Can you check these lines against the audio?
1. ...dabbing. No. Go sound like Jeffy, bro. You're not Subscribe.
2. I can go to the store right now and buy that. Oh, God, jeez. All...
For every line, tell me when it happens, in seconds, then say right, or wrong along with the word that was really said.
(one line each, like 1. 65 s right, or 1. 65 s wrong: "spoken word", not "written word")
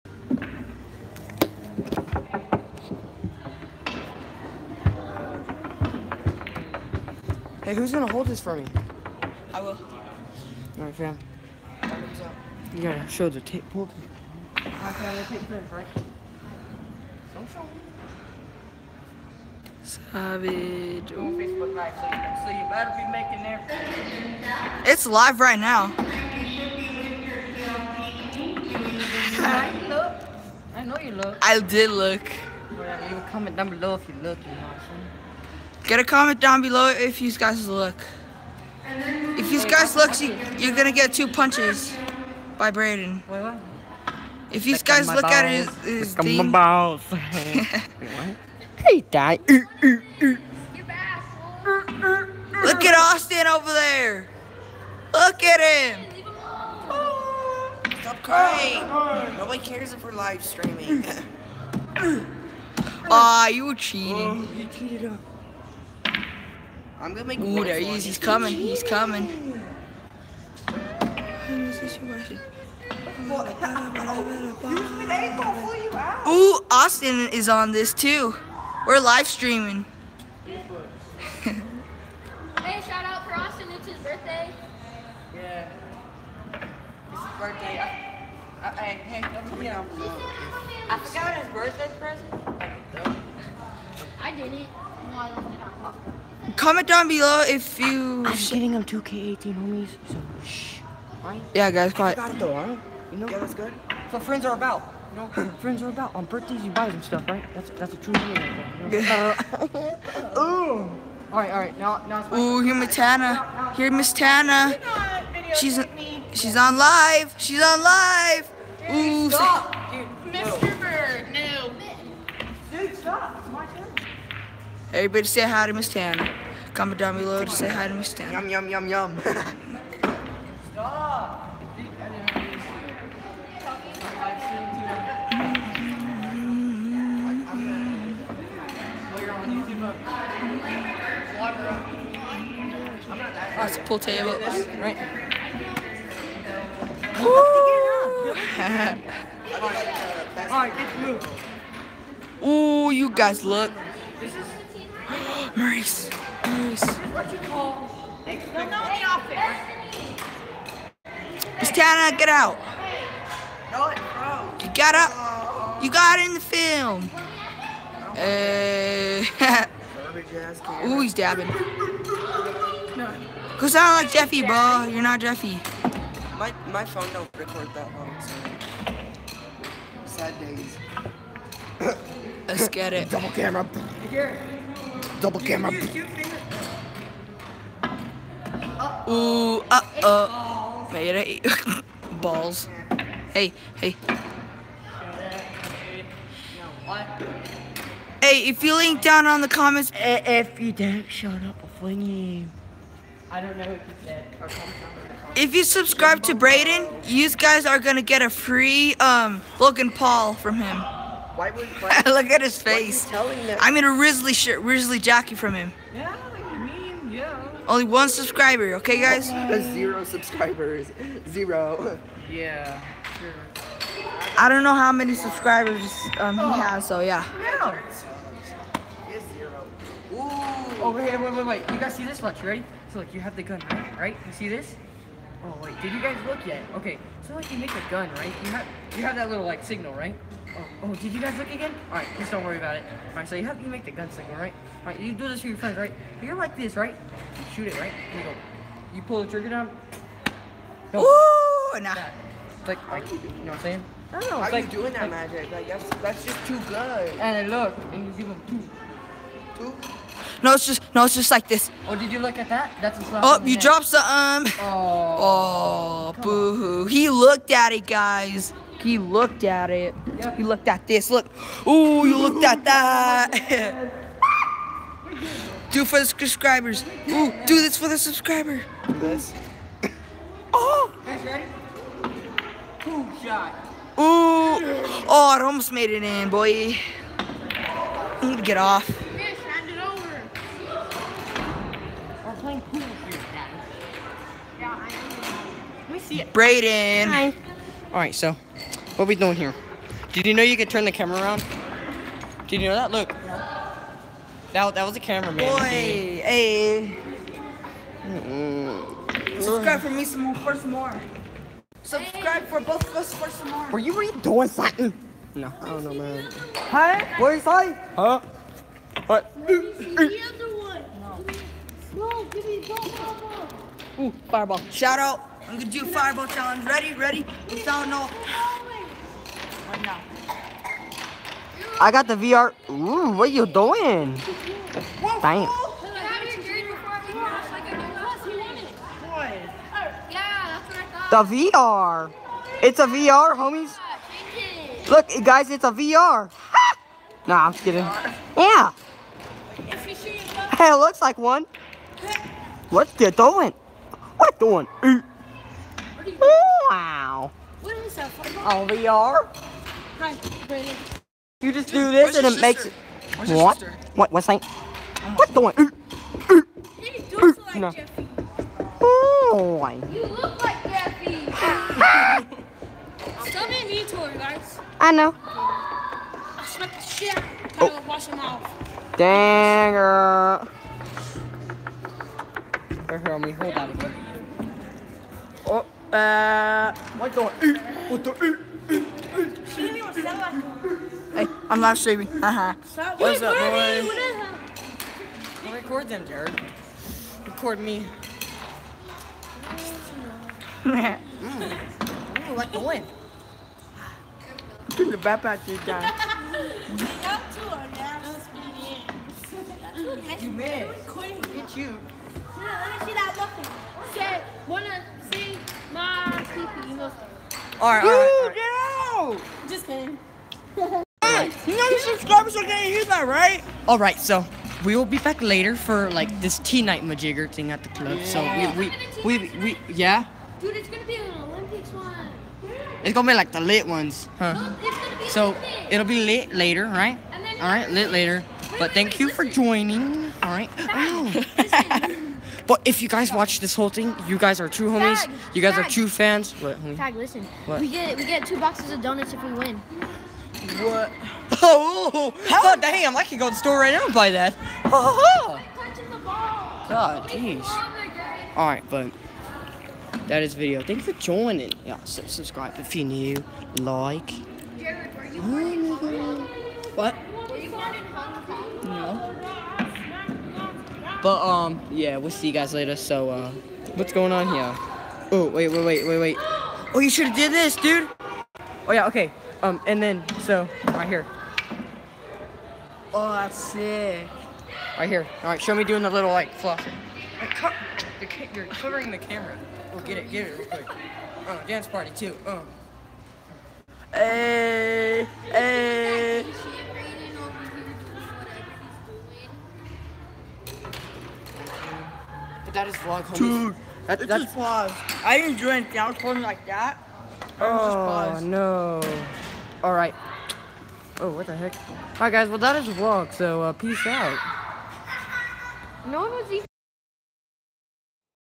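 1. 171 s wrong: "Jeffy", not "Subscribe"
2. 452 s right.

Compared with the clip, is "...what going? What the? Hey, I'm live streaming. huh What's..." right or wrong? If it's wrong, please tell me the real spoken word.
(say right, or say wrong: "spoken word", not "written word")
right.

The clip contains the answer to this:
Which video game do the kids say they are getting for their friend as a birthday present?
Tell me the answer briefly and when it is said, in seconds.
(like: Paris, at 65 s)
2K18, at 98 s.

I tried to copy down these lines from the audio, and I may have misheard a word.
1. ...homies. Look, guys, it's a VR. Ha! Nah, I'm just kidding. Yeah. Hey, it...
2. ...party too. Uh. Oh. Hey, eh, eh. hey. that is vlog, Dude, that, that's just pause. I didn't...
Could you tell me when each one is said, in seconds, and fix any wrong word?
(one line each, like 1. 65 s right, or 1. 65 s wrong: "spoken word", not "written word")
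1. 343 s right
2. 491 s right.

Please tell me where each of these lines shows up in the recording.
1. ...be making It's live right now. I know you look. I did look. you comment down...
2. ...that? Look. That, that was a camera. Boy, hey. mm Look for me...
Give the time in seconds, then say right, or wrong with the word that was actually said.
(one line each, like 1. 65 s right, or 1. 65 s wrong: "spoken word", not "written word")
1. 22 s right
2. 302 s wrong: "Subscribe", not "Look".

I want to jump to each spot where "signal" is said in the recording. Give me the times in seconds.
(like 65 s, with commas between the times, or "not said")
239 s, 243 s.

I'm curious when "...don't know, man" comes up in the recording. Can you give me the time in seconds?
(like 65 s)
315 s.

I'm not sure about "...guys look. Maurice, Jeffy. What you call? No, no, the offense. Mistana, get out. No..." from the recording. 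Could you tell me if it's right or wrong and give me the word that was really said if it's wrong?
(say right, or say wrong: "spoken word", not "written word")
wrong: "Maurice", not "Jeffy".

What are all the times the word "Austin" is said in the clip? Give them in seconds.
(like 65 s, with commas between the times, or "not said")
52 s, 76 s, 83 s.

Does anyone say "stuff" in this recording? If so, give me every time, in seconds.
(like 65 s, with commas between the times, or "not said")
107 s.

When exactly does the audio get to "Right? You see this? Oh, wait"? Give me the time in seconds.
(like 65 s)
233 s.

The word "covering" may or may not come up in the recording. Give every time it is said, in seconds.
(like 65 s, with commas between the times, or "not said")
488 s.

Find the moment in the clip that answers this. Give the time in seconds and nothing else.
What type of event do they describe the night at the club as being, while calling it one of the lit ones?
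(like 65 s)
431 s.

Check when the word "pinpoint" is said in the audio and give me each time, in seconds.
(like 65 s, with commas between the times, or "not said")
not said.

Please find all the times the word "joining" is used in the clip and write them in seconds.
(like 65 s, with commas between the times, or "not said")
439 s, 460 s.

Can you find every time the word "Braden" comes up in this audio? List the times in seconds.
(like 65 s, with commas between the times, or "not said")
42 s, 296 s.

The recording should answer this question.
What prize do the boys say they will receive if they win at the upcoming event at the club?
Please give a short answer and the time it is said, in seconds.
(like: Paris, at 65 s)
two boxes of donuts, at 448 s.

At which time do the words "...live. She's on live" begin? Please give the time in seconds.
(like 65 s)
116 s.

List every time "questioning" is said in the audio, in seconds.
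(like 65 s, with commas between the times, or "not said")
not said.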